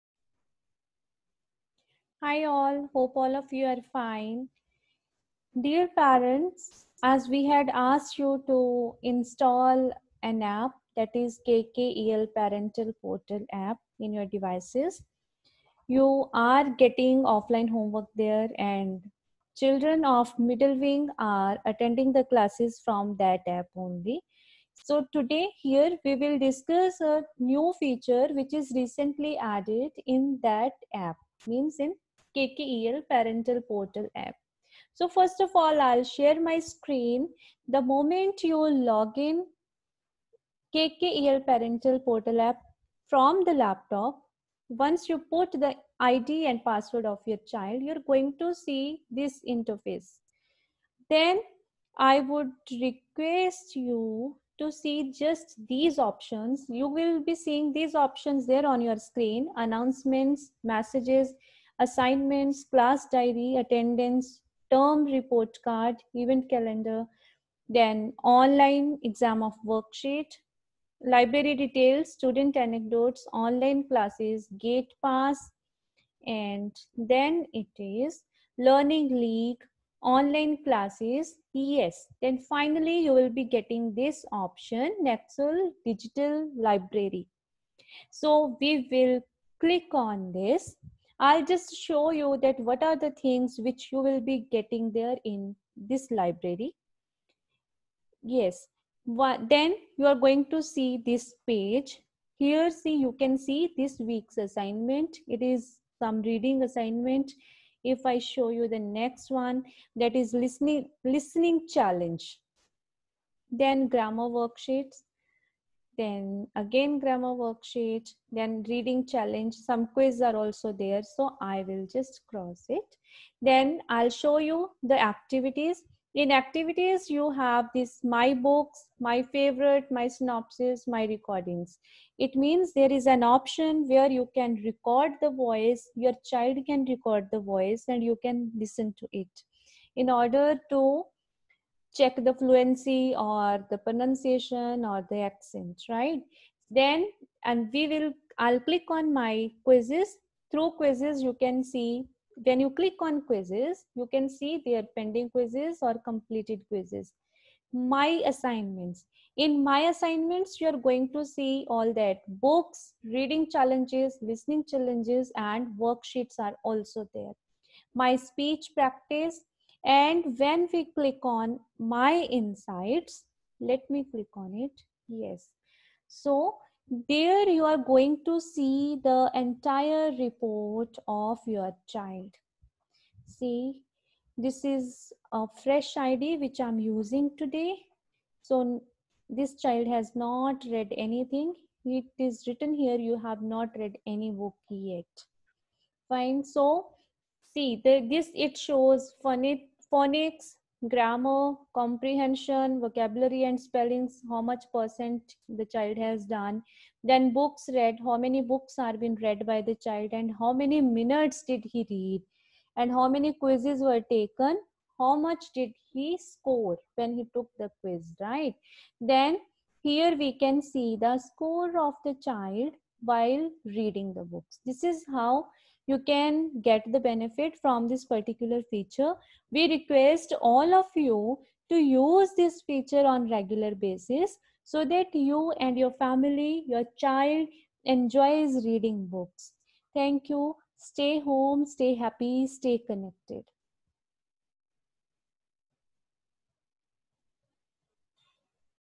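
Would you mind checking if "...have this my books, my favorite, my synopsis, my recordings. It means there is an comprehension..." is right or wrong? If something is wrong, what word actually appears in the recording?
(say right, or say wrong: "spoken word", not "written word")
wrong: "option", not "comprehension".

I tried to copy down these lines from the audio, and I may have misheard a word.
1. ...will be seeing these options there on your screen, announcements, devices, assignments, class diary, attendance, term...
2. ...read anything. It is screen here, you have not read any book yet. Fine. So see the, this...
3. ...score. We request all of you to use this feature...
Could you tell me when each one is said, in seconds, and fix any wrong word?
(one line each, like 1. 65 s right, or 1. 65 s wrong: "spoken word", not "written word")
1. 56 s wrong: "messages", not "devices"
2. 190 s wrong: "written", not "screen"
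3. 228 s wrong: "feature", not "score".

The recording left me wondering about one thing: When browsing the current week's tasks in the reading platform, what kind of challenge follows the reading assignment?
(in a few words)
Listening challenge.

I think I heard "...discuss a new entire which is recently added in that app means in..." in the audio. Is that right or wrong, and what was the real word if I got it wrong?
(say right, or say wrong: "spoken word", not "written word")
wrong: "feature", not "entire".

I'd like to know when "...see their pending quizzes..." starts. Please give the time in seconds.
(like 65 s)
154 s.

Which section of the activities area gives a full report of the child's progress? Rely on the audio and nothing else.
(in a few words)
My insights.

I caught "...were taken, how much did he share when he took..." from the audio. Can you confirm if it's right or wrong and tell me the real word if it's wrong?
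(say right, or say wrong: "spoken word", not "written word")
wrong: "score", not "share".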